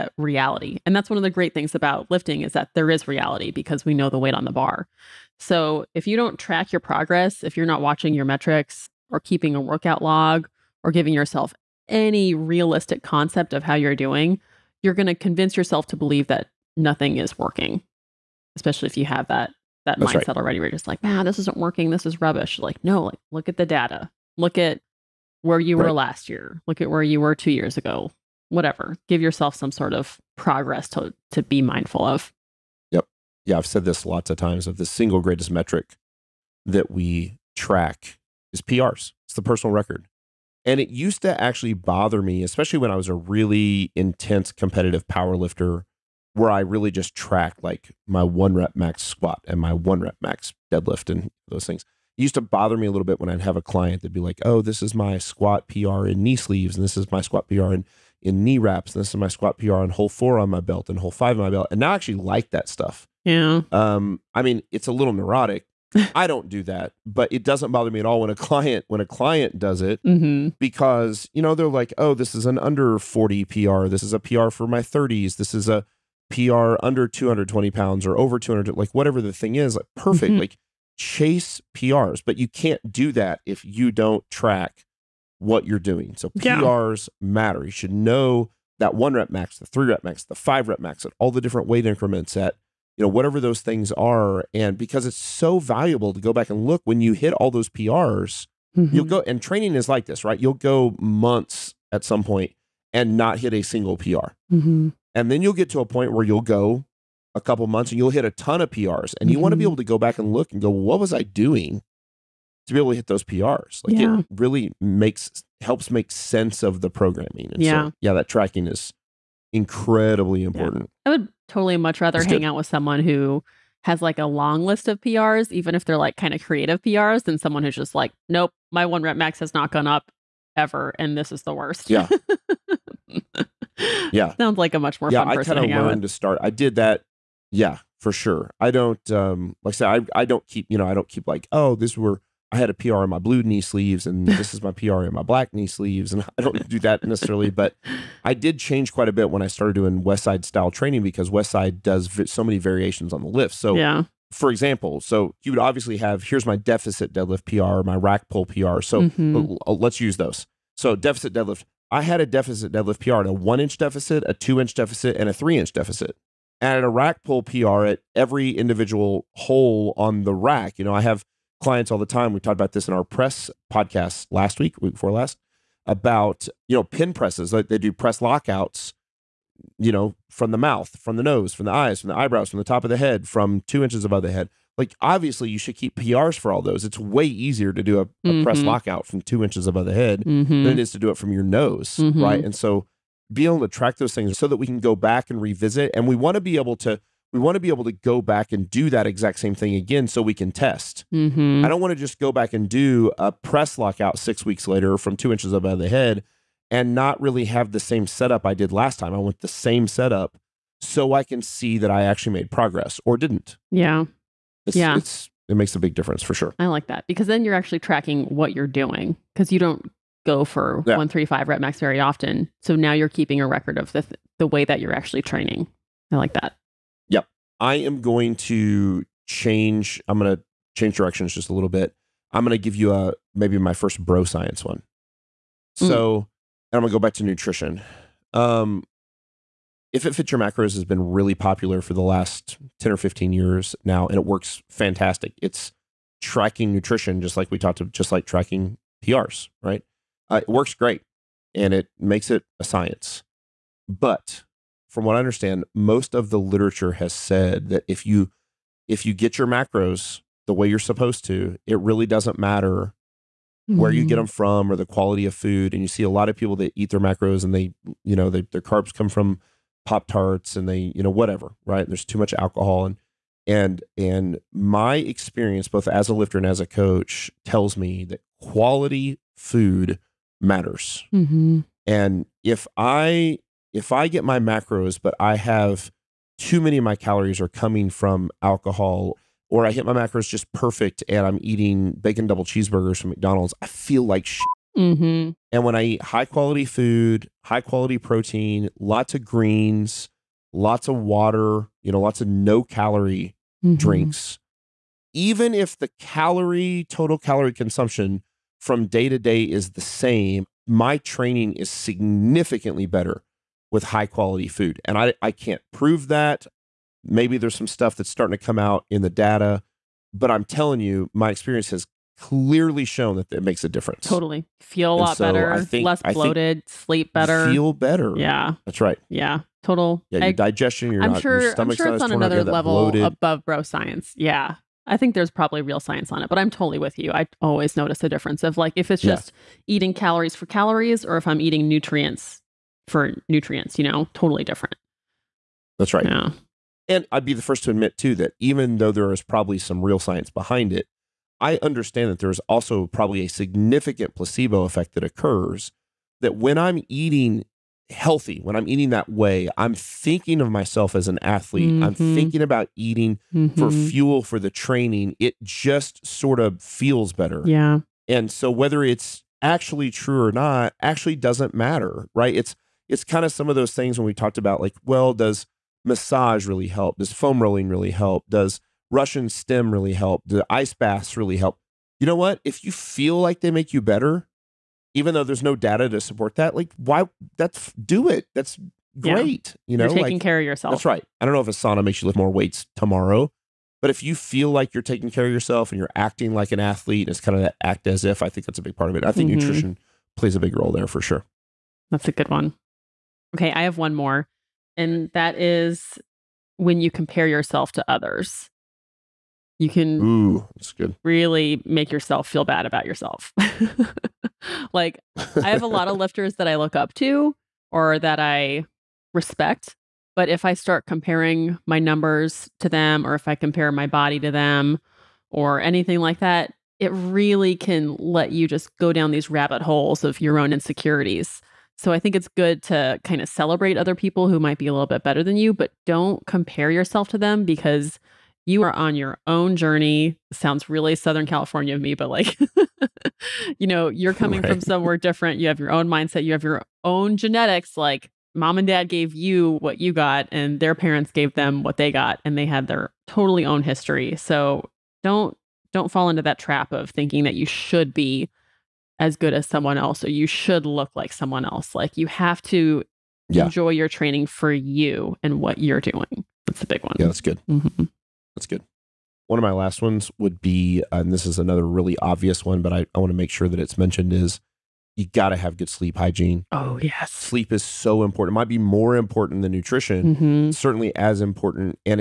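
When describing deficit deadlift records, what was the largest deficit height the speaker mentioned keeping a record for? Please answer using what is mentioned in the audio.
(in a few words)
3 inch.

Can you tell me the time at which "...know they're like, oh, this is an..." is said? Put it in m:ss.
1:11.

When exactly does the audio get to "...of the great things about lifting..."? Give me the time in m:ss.
0:01.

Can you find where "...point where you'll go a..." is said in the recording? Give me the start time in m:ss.
1:45.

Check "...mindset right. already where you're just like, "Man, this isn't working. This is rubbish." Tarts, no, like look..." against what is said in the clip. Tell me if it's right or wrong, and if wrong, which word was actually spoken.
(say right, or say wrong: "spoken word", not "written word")
wrong: "Like", not "Tarts".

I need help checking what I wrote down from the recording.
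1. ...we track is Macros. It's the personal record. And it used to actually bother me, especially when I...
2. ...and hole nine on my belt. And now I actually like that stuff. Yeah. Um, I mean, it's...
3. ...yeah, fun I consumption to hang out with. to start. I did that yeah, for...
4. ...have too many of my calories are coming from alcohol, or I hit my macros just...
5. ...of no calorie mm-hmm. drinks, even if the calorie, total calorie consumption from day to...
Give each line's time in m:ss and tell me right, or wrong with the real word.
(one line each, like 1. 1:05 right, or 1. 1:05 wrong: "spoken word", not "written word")
1. 0:36 wrong: "PRs", not "Macros"
2. 1:00 wrong: "five", not "nine"
3. 2:15 wrong: "person", not "consumption"
4. 4:45 right
5. 5:02 right.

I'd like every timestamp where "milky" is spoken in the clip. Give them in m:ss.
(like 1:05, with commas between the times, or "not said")
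not said.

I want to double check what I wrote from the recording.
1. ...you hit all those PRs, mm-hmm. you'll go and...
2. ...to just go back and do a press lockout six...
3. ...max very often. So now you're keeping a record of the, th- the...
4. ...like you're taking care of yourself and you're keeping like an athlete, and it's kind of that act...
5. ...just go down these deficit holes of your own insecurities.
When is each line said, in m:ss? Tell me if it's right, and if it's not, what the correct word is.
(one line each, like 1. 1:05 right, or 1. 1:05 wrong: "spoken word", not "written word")
1. 1:36 right
2. 3:21 right
3. 3:41 right
4. 6:34 wrong: "acting", not "keeping"
5. 7:08 wrong: "rabbit", not "deficit".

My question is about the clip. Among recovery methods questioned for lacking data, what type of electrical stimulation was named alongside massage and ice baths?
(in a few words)
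Russian stim.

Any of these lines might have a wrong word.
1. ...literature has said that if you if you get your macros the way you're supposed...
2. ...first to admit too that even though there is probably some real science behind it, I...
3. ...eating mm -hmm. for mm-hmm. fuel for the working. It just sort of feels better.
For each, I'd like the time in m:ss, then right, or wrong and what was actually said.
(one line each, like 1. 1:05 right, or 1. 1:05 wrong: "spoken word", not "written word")
1. 4:16 right
2. 5:47 right
3. 6:02 wrong: "training", not "working".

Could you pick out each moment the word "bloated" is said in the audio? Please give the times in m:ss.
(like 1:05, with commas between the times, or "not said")
5:26, 5:32.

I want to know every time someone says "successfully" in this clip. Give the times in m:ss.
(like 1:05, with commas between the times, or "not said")
not said.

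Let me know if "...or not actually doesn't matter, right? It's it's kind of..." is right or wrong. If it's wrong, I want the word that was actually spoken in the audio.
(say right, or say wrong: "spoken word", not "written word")
right.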